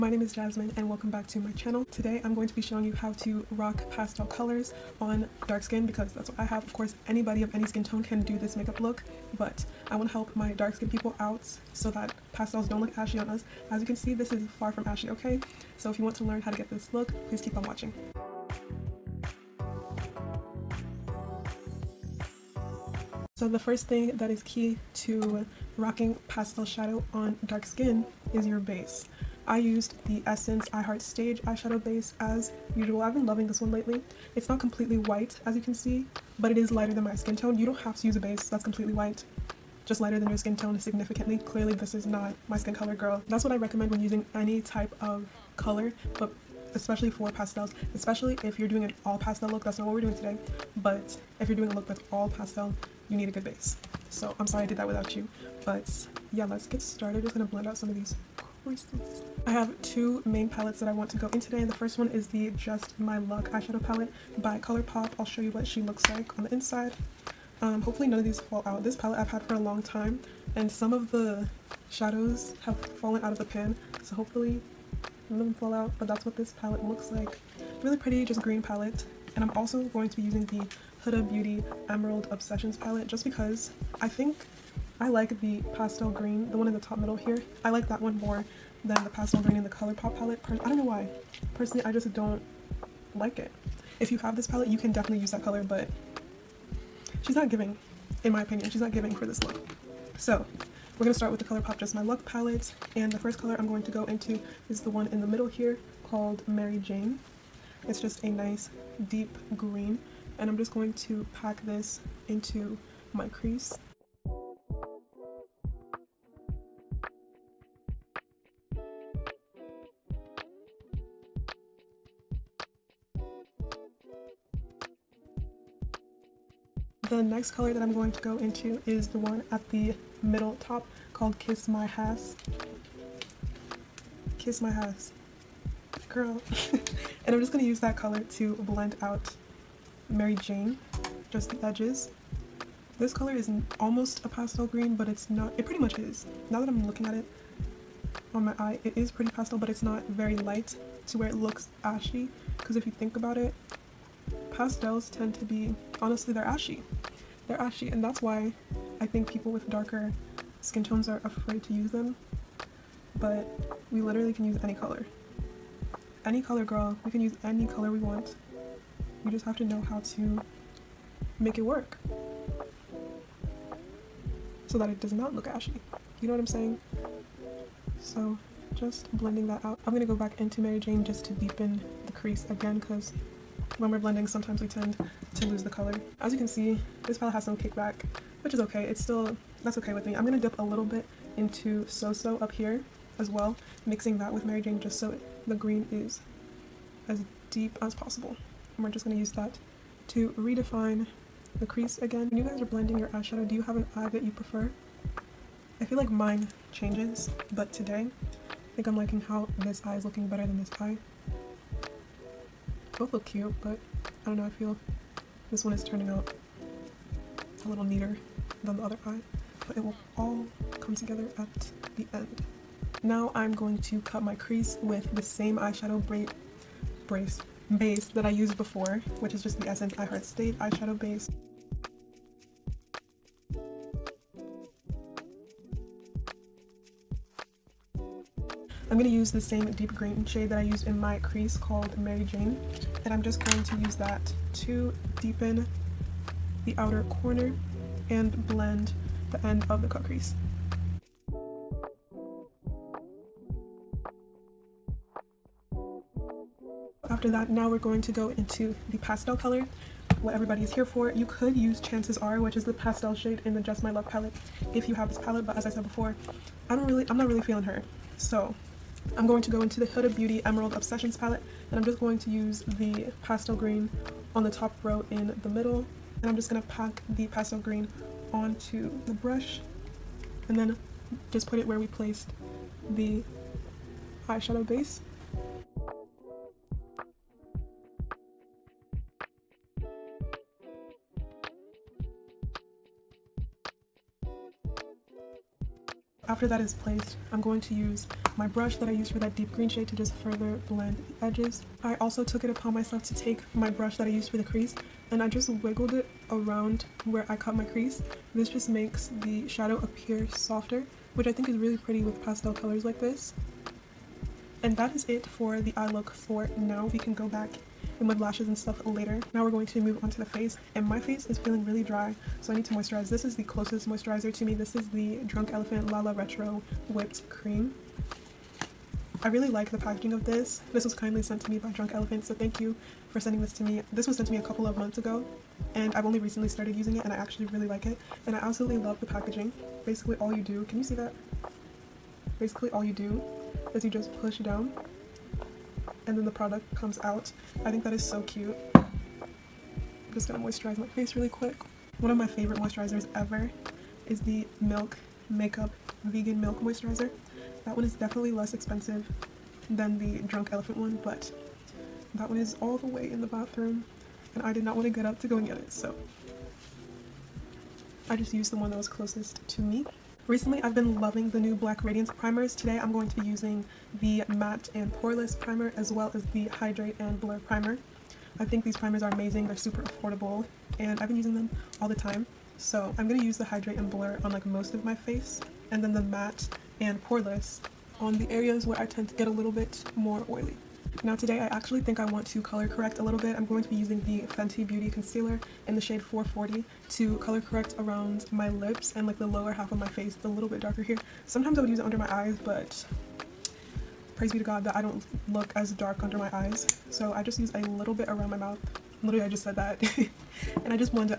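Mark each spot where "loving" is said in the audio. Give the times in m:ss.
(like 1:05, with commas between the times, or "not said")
0:33, 6:10.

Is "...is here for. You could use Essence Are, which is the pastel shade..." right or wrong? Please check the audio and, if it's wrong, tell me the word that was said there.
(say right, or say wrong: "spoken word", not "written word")
wrong: "Chances", not "Essence".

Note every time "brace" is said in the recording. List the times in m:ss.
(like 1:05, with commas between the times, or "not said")
3:47.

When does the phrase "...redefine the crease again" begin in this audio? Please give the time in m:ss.
3:20.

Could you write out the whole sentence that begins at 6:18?
I think these primers are amazing.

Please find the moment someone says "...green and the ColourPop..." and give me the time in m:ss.
1:29.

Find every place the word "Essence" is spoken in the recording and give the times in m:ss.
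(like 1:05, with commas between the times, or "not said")
0:30, 3:49.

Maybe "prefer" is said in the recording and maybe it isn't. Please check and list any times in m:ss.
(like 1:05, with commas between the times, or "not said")
3:24.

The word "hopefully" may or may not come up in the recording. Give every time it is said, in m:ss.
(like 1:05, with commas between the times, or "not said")
1:07, 1:14.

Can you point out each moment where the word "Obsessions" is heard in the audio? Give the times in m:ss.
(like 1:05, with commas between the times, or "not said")
1:22, 4:30.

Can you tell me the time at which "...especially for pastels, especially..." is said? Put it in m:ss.
0:46.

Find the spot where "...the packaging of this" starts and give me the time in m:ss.
5:29.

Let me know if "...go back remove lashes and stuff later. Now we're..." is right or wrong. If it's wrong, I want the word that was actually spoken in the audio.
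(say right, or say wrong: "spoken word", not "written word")
right.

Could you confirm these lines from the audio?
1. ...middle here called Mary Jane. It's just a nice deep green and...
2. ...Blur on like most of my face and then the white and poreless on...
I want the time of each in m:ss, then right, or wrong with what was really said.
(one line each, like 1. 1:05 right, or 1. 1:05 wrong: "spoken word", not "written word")
1. 1:45 right
2. 6:23 wrong: "matte", not "white".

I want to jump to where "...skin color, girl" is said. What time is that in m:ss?
0:42.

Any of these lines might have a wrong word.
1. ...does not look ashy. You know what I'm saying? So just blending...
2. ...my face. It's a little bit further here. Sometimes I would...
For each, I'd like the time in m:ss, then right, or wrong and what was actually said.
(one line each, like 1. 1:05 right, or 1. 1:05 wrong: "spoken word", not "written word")
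1. 2:54 right
2. 6:39 wrong: "darker", not "further".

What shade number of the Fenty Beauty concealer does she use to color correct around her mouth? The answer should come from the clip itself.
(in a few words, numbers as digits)
440.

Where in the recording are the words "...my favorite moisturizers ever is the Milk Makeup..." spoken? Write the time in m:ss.
5:52.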